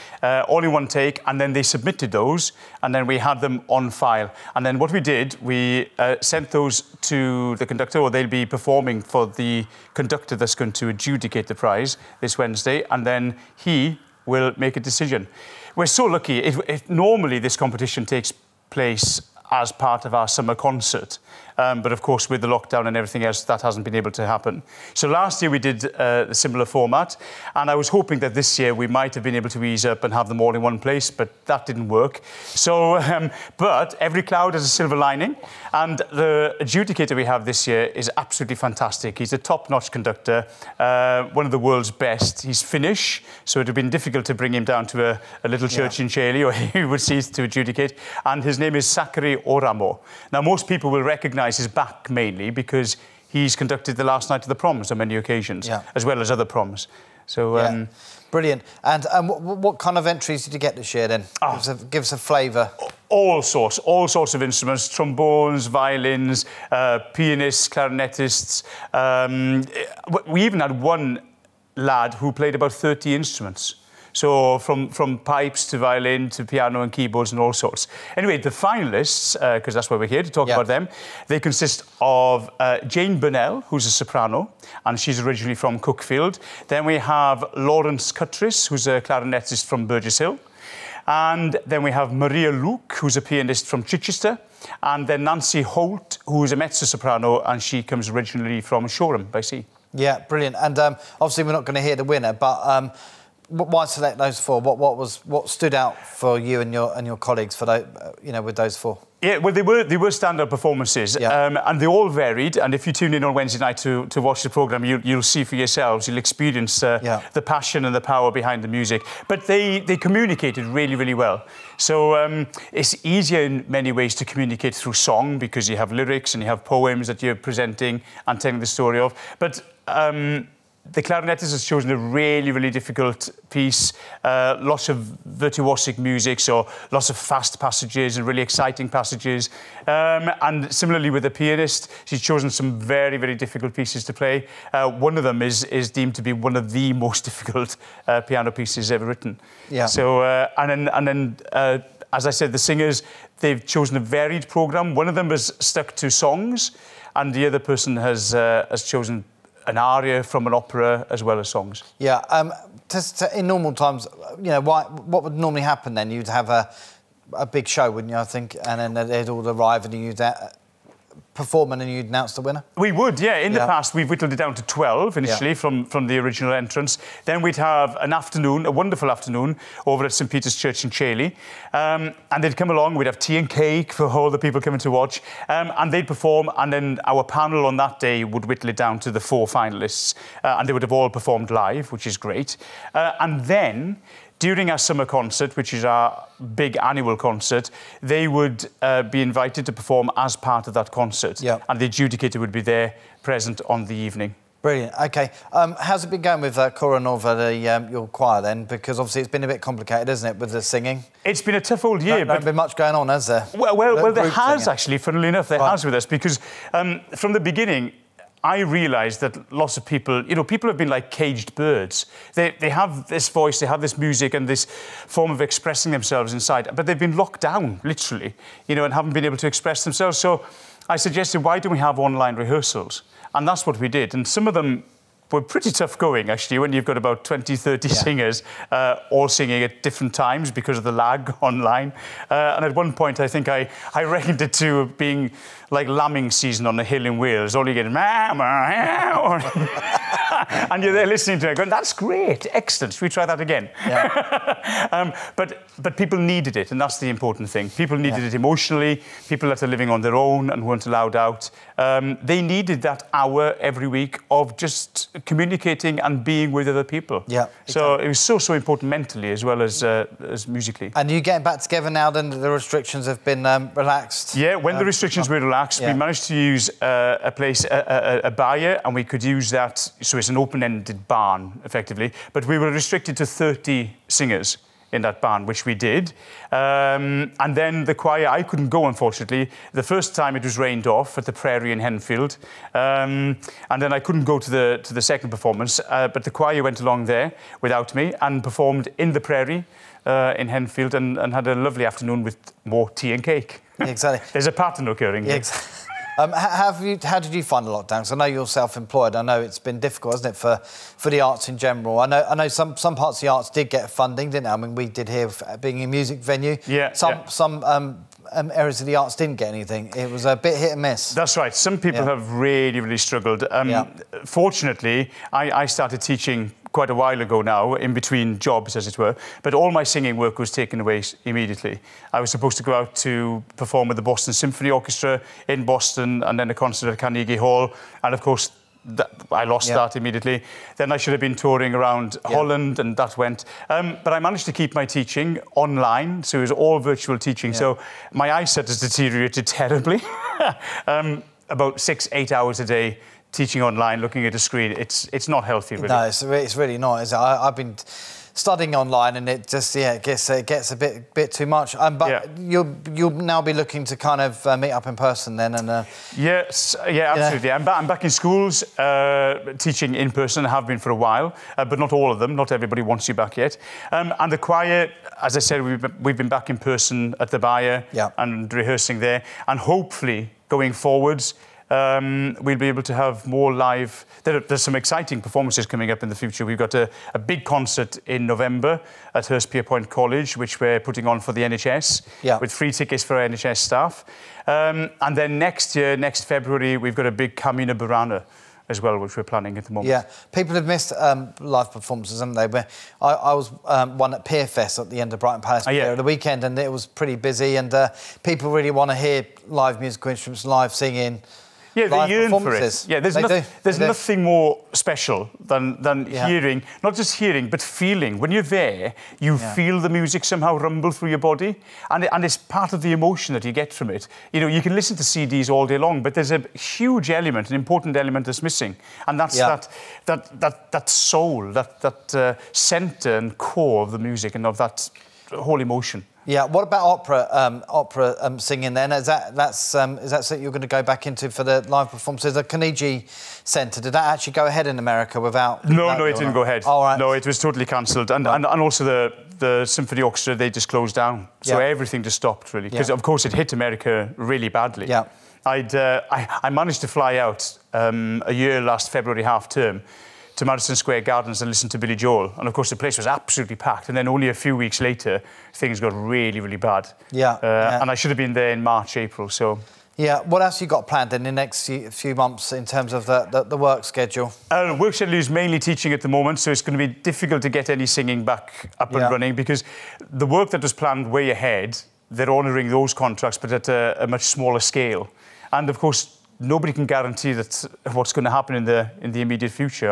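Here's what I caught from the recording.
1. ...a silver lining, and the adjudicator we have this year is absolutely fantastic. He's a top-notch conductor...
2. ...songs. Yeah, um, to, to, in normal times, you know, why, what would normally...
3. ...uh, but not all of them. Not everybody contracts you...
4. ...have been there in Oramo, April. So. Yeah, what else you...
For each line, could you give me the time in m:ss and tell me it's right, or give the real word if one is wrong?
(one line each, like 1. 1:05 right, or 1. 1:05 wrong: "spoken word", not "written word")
1. 0:34 right
2. 2:41 right
3. 6:11 wrong: "wants", not "contracts"
4. 7:48 wrong: "March", not "Oramo".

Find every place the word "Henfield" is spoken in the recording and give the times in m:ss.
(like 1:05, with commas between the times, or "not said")
4:51, 5:00.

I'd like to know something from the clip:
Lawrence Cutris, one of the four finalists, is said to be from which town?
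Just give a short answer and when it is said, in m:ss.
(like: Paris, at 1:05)
Burgess Hill, at 1:29.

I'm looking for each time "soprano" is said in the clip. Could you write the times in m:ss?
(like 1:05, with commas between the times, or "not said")
1:23, 1:36.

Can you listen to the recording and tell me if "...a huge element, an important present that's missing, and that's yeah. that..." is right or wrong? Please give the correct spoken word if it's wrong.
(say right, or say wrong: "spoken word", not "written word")
wrong: "element", not "present".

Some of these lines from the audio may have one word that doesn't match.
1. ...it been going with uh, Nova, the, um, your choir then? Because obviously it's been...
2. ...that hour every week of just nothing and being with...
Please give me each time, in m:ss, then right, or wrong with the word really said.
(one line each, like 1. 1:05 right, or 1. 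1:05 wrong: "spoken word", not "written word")
1. 3:26 right
2. 4:22 wrong: "communicating", not "nothing".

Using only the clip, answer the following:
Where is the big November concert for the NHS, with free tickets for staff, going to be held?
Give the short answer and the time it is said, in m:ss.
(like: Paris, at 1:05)
Hurstpierpoint College, at 6:29.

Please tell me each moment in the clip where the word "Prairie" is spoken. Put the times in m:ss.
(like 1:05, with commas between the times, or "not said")
4:51, 4:59.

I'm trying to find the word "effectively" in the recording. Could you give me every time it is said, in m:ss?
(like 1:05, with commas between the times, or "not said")
4:41.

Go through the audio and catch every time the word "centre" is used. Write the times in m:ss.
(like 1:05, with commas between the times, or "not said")
7:12, 7:23.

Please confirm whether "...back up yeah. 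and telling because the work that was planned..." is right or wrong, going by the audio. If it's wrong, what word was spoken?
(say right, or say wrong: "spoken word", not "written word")
wrong: "running", not "telling".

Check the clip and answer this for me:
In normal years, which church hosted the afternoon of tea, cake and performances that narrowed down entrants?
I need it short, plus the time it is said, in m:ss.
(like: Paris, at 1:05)
St Peter's Church, at 3:00.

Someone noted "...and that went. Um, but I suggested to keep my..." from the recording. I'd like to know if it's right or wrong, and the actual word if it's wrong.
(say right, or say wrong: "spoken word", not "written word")
wrong: "managed", not "suggested".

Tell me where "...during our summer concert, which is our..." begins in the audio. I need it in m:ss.
3:14.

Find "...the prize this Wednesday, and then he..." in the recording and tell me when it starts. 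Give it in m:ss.
0:11.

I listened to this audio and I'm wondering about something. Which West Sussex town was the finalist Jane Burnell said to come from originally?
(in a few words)
Cuckfield.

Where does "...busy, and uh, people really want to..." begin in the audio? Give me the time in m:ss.
6:47.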